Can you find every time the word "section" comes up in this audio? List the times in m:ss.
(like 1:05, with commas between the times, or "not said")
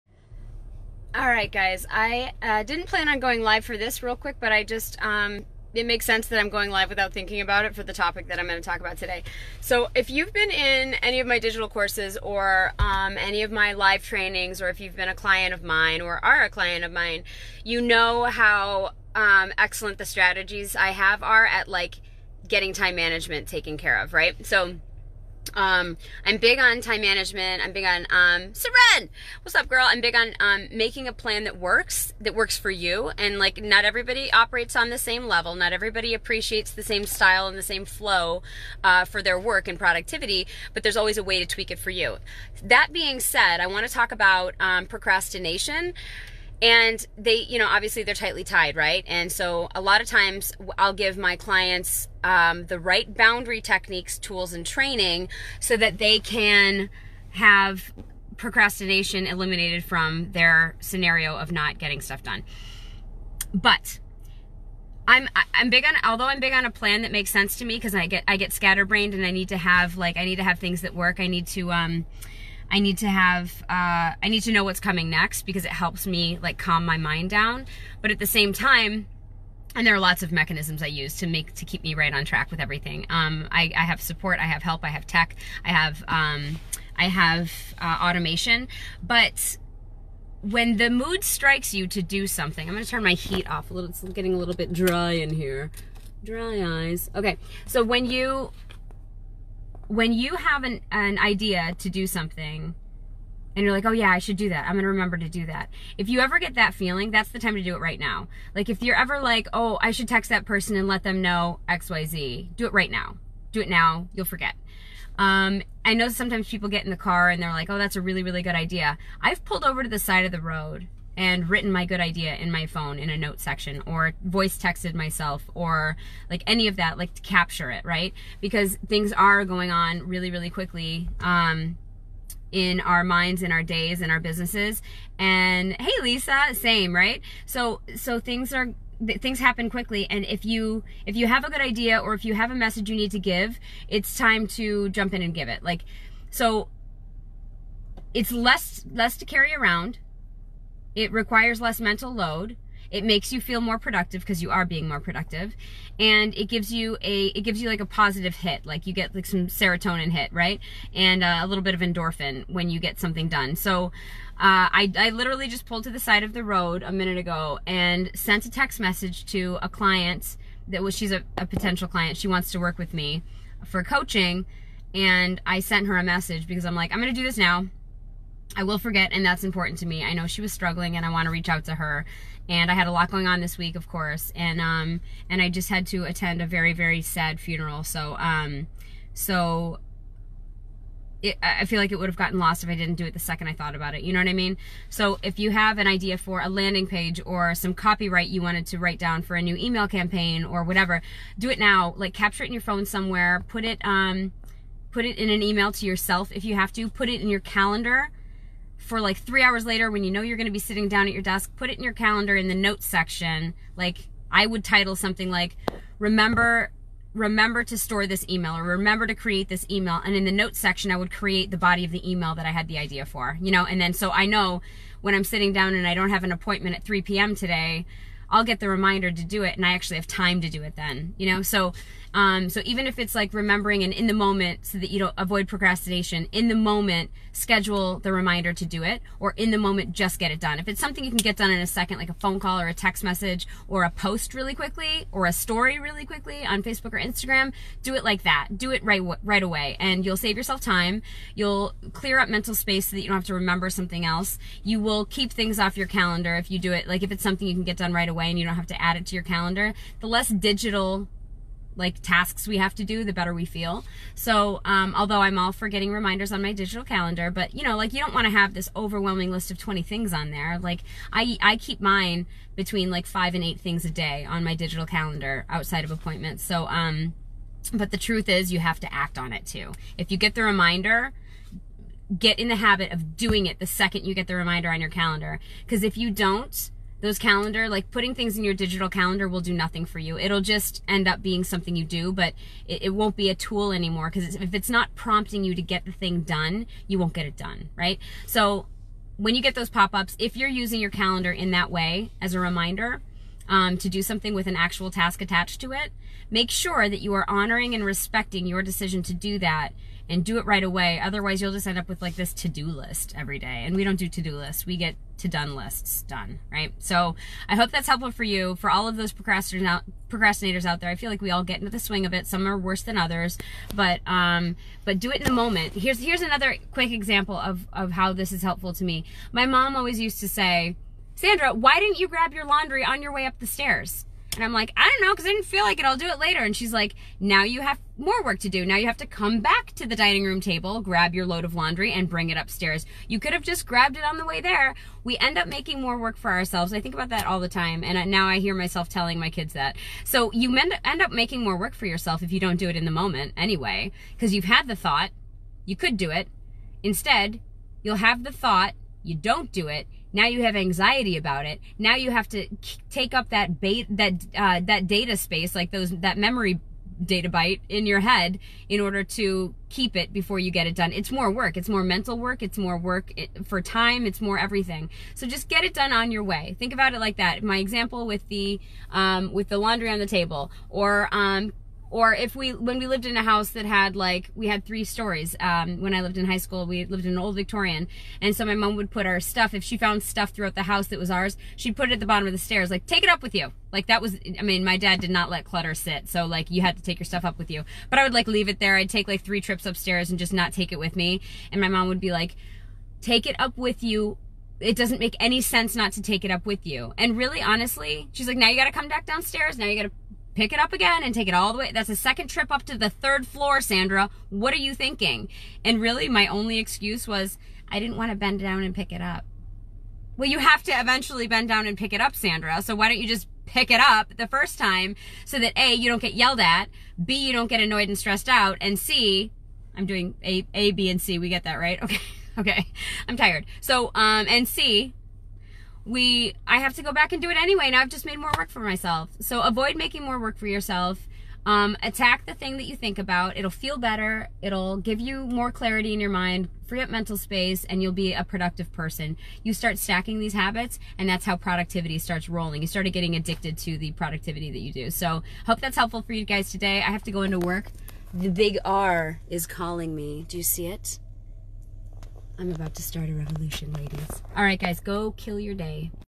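2:03, 3:32, 3:40.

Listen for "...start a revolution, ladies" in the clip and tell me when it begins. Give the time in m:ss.
7:42.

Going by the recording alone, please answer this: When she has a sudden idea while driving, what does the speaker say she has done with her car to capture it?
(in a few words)
Pulled over to the side of the road.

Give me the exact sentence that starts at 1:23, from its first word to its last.
Um, I, I, have support, I have help, I have tech, I have um, I have uh, automation.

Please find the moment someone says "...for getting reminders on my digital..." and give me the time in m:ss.
4:25.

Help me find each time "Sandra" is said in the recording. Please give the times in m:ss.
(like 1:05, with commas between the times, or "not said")
5:31, 6:53, 7:02.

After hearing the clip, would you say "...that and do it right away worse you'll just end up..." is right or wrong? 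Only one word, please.
wrong.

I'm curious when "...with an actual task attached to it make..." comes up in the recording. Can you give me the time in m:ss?
5:04.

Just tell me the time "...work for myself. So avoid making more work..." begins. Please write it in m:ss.
7:18.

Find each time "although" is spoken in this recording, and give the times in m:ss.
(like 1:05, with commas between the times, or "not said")
1:06, 4:24.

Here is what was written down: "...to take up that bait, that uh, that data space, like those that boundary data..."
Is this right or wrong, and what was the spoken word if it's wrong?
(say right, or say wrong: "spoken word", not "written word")
wrong: "memory", not "boundary".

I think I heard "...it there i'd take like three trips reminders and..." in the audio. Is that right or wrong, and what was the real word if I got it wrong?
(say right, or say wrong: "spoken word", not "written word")
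wrong: "upstairs", not "reminders".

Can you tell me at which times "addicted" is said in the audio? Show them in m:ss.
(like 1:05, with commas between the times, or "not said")
7:33.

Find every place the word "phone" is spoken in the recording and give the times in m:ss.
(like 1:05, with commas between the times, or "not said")
2:02, 3:22, 4:02.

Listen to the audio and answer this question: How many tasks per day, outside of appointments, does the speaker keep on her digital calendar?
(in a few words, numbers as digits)
5 to 8.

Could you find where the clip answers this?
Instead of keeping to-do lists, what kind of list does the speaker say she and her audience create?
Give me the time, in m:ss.
5:15.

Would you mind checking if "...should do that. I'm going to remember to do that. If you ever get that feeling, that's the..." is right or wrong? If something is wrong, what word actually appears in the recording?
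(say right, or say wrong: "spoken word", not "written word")
right.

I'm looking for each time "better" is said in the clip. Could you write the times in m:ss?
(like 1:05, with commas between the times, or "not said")
4:23, 7:23.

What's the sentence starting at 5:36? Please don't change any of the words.
And she's like, now you have more work to do.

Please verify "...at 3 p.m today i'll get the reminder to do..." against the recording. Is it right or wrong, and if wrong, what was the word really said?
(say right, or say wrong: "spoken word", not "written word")
right.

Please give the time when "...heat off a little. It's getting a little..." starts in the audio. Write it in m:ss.
1:33.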